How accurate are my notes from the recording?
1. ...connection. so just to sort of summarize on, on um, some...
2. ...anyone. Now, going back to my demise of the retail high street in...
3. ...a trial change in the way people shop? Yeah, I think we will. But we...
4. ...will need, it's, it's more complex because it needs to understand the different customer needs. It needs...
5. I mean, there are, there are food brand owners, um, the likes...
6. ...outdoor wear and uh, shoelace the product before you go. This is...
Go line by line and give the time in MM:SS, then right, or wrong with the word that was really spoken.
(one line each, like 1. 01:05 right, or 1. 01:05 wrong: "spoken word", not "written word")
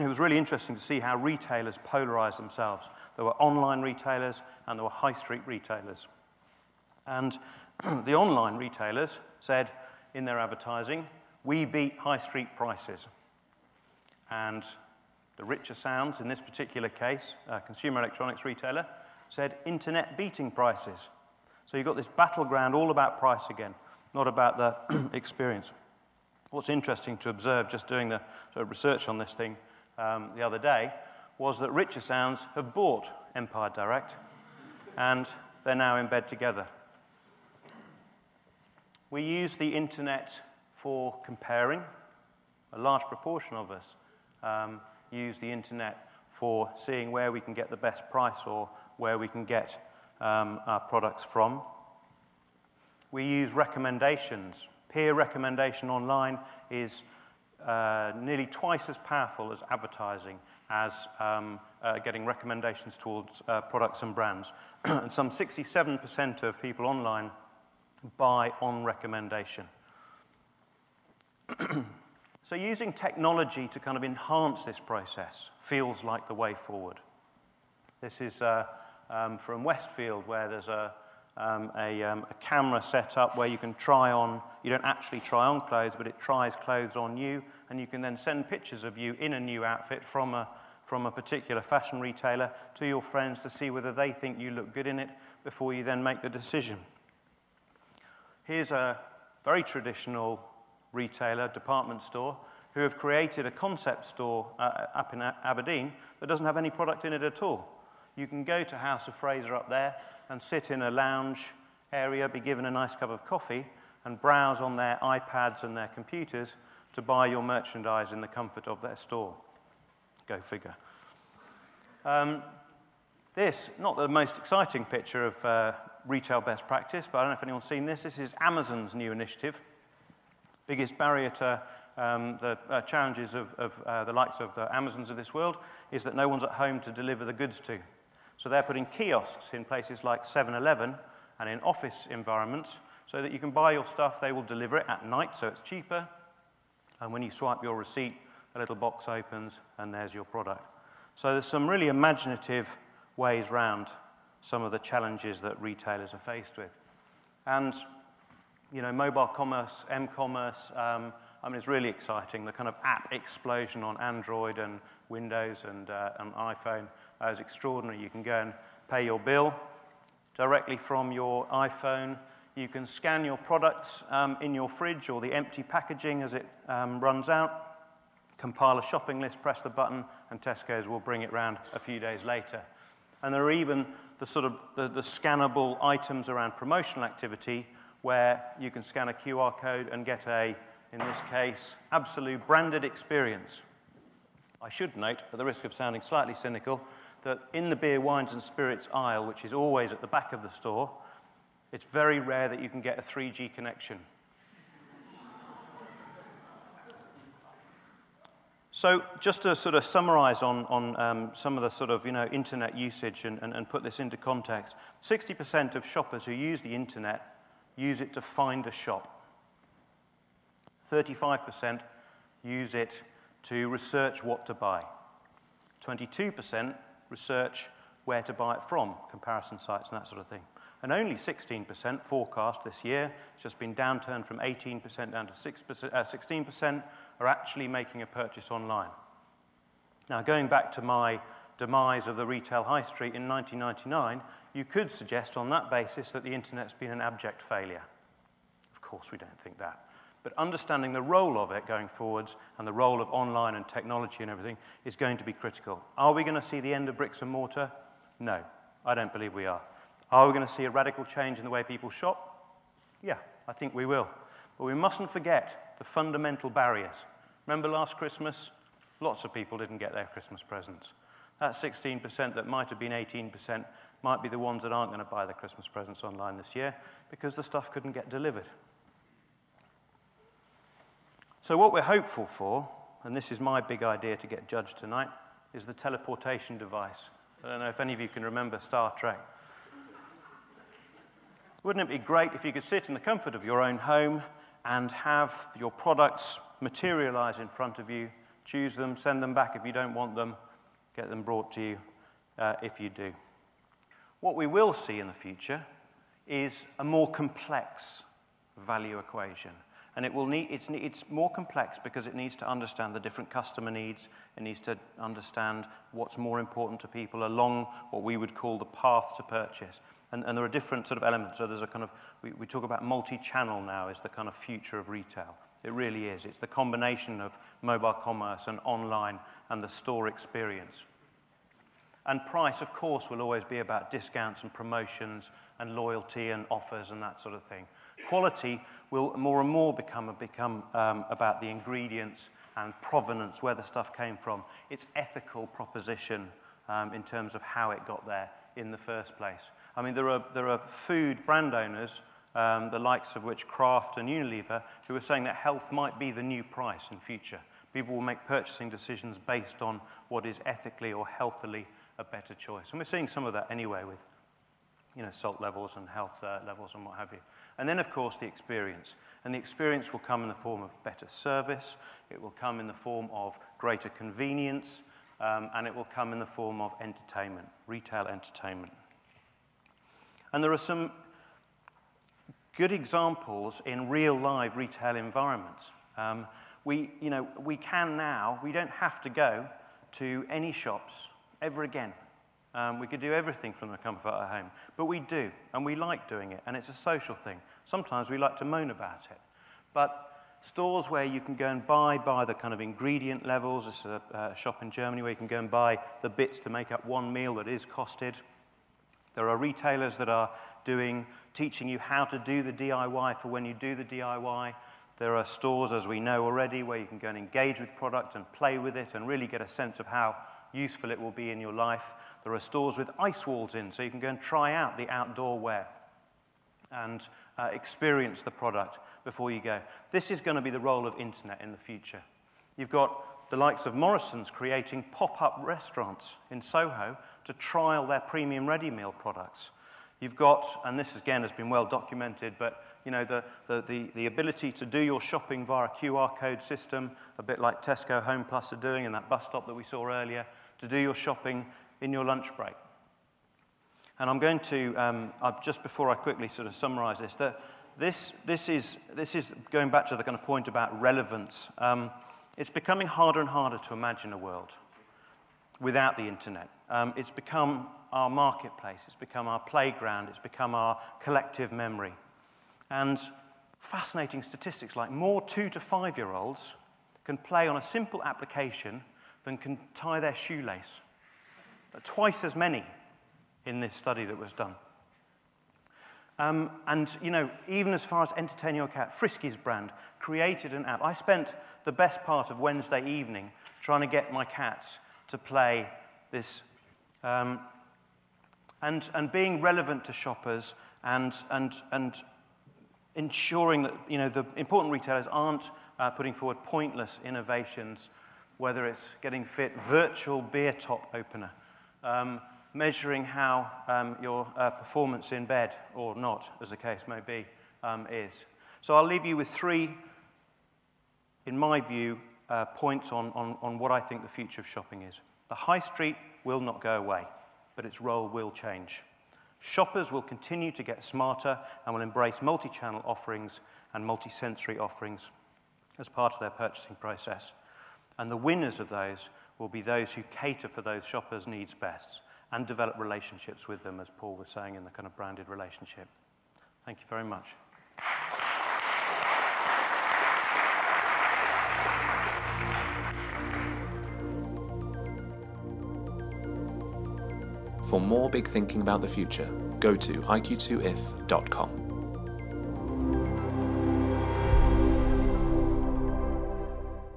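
1. 03:23 right
2. 03:58 wrong: "online", not "anyone"
3. 04:20 wrong: "radical", not "trial"
4. 05:10 right
5. 05:49 right
6. 07:04 wrong: "experience", not "shoelace".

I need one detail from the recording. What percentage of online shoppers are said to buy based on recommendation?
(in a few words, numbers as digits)
67%.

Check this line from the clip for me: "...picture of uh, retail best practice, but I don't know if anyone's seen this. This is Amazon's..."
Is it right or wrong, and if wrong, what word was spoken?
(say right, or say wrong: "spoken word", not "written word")
right.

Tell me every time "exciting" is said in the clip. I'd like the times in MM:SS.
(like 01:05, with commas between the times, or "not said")
02:04, 02:41.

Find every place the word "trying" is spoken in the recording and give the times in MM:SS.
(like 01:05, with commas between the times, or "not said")
08:13.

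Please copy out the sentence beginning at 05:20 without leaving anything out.
And, and there are different sort of elements.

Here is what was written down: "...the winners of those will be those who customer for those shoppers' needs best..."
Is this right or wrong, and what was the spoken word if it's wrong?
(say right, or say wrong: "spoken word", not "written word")
wrong: "cater", not "customer".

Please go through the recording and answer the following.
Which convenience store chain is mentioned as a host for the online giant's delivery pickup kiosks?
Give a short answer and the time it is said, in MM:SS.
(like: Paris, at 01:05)
7 Eleven, at 02:20.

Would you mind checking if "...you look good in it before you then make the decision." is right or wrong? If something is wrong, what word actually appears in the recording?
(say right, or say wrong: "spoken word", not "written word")
right.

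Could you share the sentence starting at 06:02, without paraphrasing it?
And we're seeing some of that anyway with you know, salt levels and health uh, levels and what have you.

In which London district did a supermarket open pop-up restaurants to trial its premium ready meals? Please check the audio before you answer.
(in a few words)
Soho.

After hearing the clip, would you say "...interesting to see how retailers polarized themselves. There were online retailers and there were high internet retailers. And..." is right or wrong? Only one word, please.
wrong.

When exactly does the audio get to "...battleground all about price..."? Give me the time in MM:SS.
00:22.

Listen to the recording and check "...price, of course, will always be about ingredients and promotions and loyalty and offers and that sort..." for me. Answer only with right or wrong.
wrong.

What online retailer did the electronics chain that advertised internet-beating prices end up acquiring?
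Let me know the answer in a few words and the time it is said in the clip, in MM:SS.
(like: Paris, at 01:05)
Empire Direct, at 00:33.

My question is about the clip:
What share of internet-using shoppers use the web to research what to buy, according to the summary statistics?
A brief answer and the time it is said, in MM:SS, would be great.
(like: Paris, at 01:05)
35%, at 03:40.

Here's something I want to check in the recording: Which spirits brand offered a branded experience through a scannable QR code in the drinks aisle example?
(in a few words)
Absolut.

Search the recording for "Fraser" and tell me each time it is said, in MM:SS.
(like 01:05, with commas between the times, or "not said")
01:49.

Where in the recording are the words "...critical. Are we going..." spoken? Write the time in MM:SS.
04:15.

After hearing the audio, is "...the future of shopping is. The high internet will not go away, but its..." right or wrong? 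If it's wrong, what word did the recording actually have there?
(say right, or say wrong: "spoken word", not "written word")
wrong: "street", not "internet".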